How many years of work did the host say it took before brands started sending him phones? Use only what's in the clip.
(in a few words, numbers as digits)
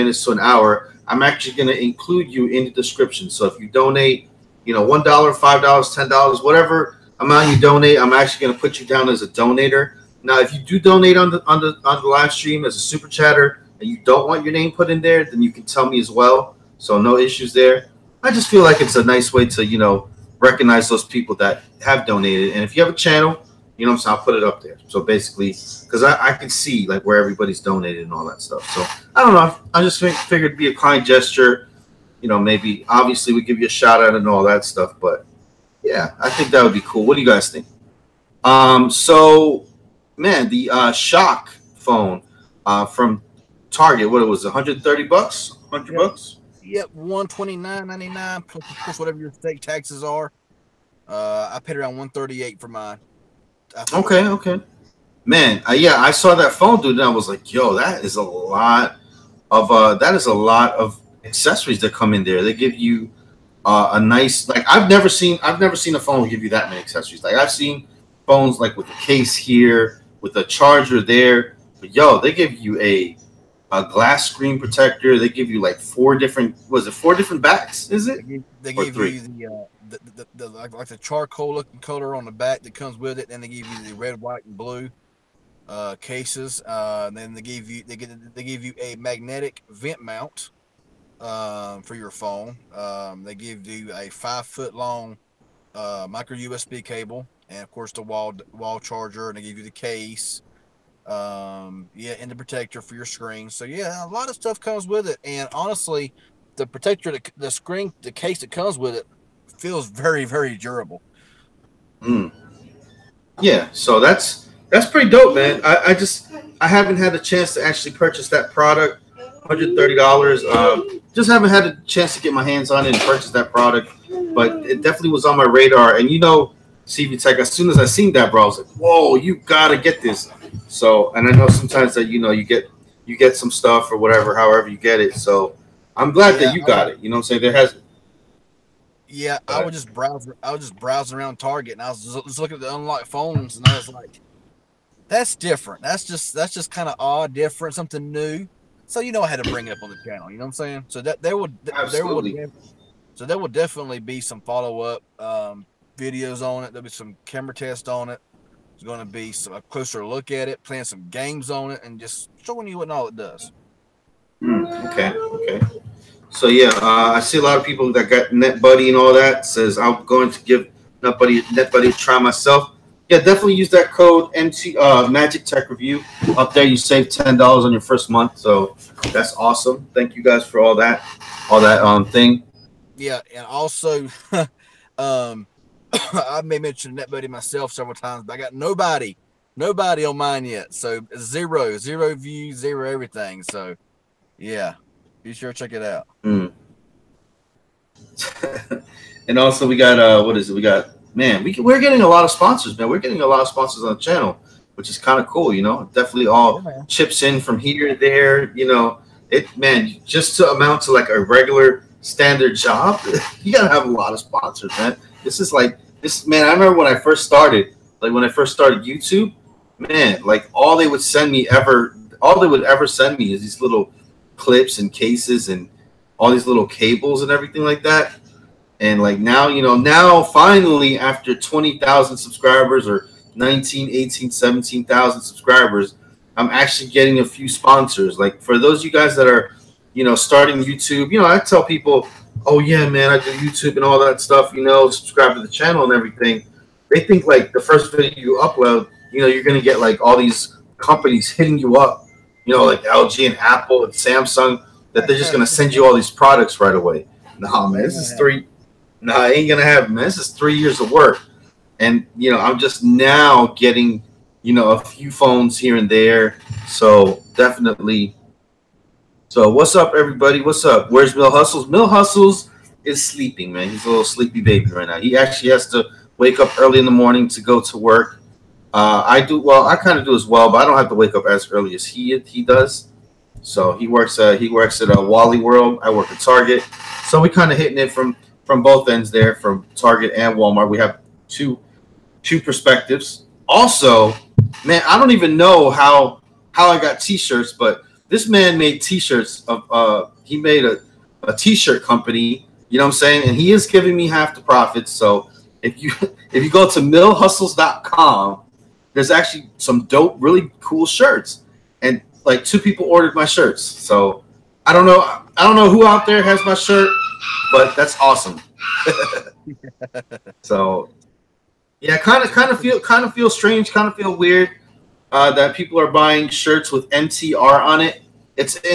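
3.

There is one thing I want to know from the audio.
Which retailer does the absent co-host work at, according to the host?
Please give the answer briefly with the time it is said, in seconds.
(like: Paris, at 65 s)
Walmart, at 285 s.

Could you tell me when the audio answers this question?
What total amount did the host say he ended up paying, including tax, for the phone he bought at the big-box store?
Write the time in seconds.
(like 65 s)
51 s.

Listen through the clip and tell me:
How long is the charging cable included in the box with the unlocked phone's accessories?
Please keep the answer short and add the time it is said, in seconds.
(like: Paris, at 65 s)
5 feet, at 94 s.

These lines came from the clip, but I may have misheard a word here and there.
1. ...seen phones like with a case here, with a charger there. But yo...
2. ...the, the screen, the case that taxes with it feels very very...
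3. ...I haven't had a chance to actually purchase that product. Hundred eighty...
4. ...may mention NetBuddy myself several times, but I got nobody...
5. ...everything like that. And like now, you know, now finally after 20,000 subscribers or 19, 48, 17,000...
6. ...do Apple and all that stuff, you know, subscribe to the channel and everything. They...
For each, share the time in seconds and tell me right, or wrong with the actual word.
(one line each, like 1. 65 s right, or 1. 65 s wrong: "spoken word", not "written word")
1. 67 s right
2. 107 s wrong: "comes", not "taxes"
3. 116 s wrong: "thirty", not "eighty"
4. 186 s right
5. 227 s wrong: "18", not "48"
6. 243 s wrong: "YouTube", not "Apple".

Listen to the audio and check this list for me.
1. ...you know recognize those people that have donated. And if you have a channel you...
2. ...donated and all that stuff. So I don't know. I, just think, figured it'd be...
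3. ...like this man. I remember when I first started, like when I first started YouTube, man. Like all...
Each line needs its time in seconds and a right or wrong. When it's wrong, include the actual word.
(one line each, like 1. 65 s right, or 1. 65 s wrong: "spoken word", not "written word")
1. 19 s right
2. 27 s right
3. 215 s right.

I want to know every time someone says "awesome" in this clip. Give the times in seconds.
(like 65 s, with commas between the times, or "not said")
179 s, 317 s.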